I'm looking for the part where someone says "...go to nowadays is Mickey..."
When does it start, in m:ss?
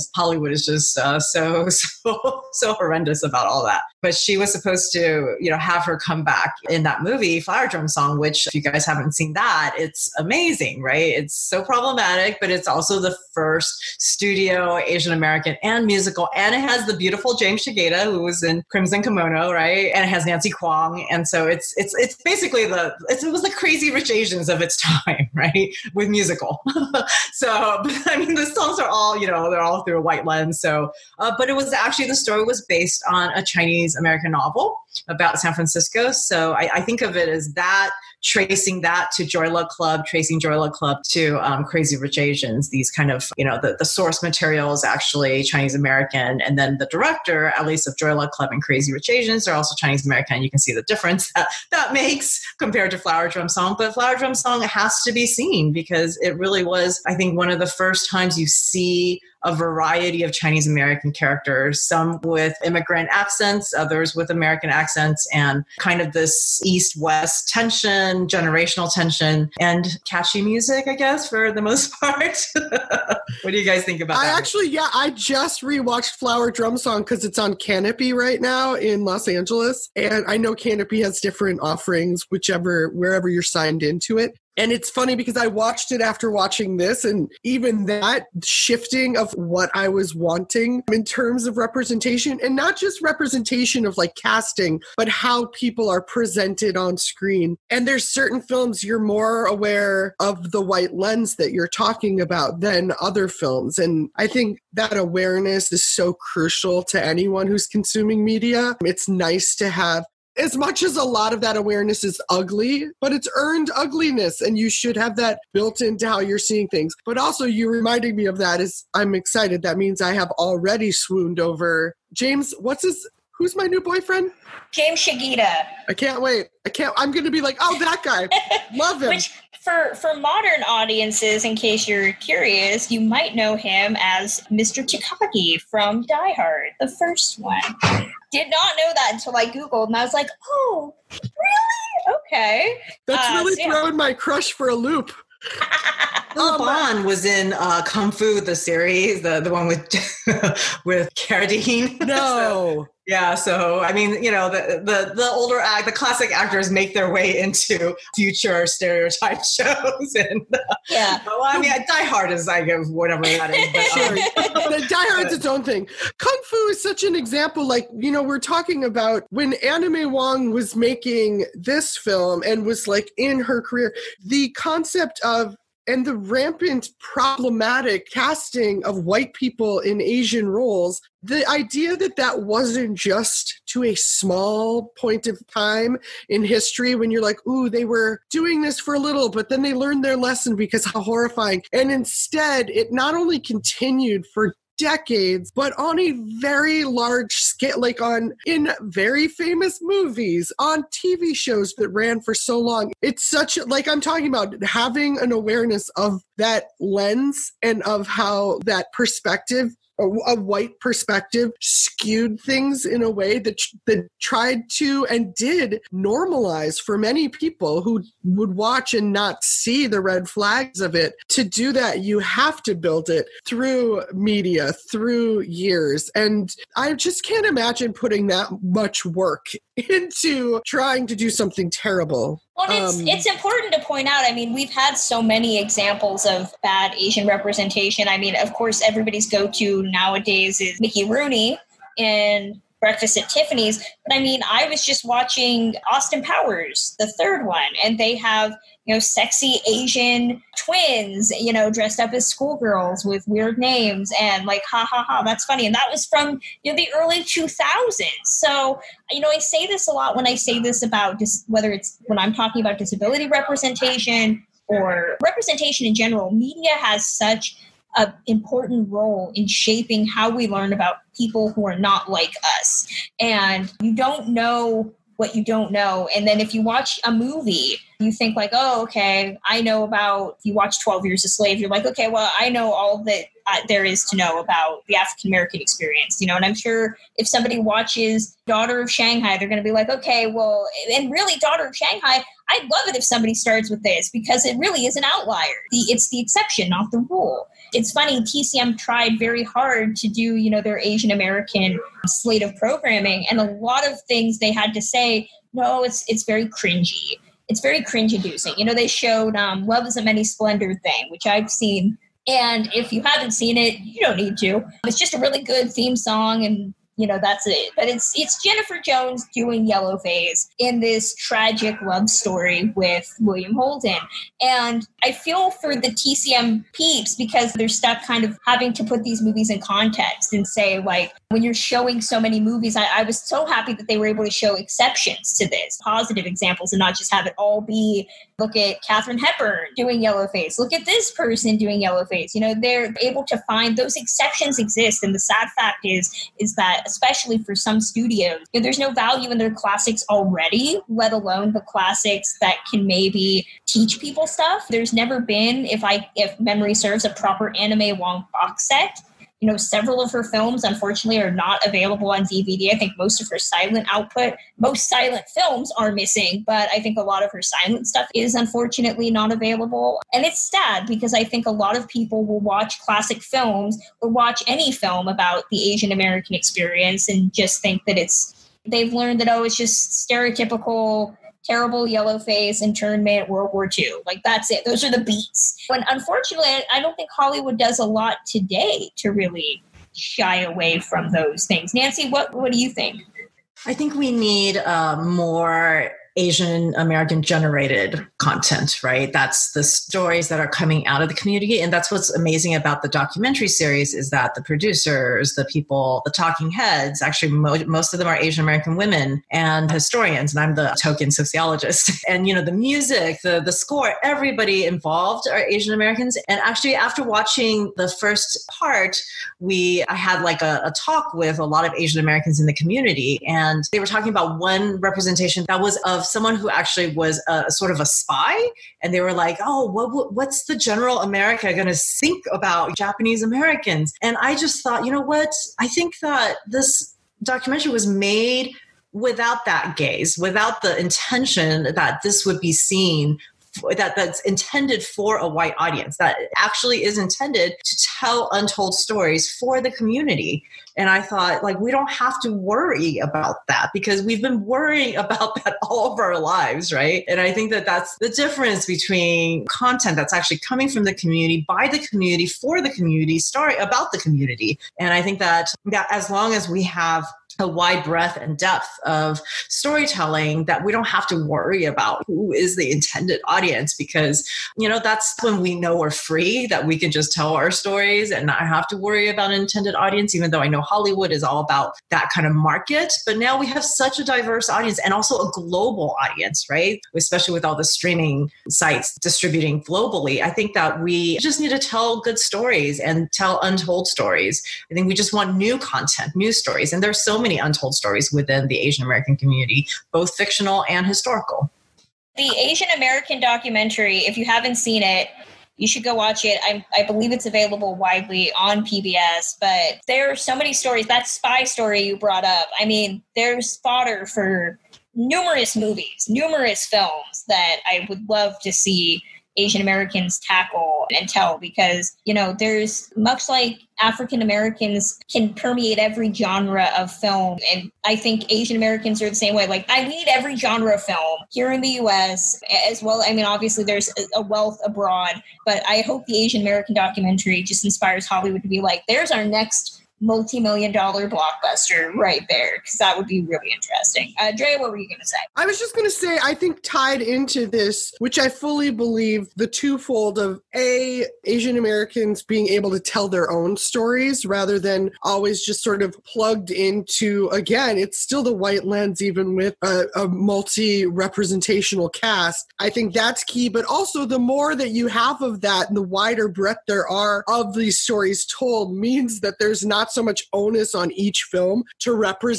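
3:59.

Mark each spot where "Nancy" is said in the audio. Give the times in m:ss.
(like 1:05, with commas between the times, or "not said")
0:20, 6:31.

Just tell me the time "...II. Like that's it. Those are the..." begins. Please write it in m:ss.
6:23.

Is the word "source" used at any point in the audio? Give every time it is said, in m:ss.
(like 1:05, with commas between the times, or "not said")
0:43.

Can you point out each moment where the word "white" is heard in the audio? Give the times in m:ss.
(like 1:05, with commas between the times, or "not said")
0:30, 1:40, 2:59, 3:30, 7:25, 9:18.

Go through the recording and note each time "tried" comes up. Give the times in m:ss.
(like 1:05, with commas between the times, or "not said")
3:34, 4:58.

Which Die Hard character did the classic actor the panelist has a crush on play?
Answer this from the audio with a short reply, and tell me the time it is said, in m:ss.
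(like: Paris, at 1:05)
Mr. Takagi, at 2:14.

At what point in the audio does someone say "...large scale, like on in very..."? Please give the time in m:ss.
3:16.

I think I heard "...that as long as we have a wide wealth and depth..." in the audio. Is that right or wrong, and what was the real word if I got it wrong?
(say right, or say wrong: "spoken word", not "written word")
wrong: "breadth", not "wealth".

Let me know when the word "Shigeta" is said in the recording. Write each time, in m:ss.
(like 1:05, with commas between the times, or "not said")
0:17, 2:05.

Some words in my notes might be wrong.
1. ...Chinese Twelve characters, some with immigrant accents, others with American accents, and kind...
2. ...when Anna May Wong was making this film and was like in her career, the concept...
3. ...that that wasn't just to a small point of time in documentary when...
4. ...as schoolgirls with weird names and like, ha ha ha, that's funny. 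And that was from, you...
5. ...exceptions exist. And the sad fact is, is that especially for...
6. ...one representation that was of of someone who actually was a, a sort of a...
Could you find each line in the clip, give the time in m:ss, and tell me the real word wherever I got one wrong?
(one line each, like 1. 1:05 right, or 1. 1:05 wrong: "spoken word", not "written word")
1. 1:00 wrong: "American", not "Twelve"
2. 2:49 right
3. 3:01 wrong: "history", not "documentary"
4. 4:12 right
5. 5:43 right
6. 7:04 right.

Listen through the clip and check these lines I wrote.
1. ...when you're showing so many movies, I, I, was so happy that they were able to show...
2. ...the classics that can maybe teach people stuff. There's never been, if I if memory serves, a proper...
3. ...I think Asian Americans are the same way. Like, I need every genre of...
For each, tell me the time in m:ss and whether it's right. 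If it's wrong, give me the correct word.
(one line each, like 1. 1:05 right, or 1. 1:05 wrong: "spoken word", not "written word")
1. 5:31 right
2. 5:51 right
3. 8:47 right.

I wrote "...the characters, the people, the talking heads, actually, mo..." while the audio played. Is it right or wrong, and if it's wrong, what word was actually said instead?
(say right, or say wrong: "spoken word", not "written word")
wrong: "producers", not "characters".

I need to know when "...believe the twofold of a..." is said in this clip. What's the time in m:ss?
9:08.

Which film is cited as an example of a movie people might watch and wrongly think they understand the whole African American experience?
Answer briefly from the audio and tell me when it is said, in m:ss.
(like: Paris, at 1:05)
Twelve Years a Slave, at 4:40.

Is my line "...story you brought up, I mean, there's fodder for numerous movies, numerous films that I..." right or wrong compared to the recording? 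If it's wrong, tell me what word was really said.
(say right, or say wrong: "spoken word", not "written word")
right.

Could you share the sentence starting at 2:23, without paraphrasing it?
That's uh, really so, thrown yeah.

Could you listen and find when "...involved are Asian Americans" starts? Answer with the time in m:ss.
6:54.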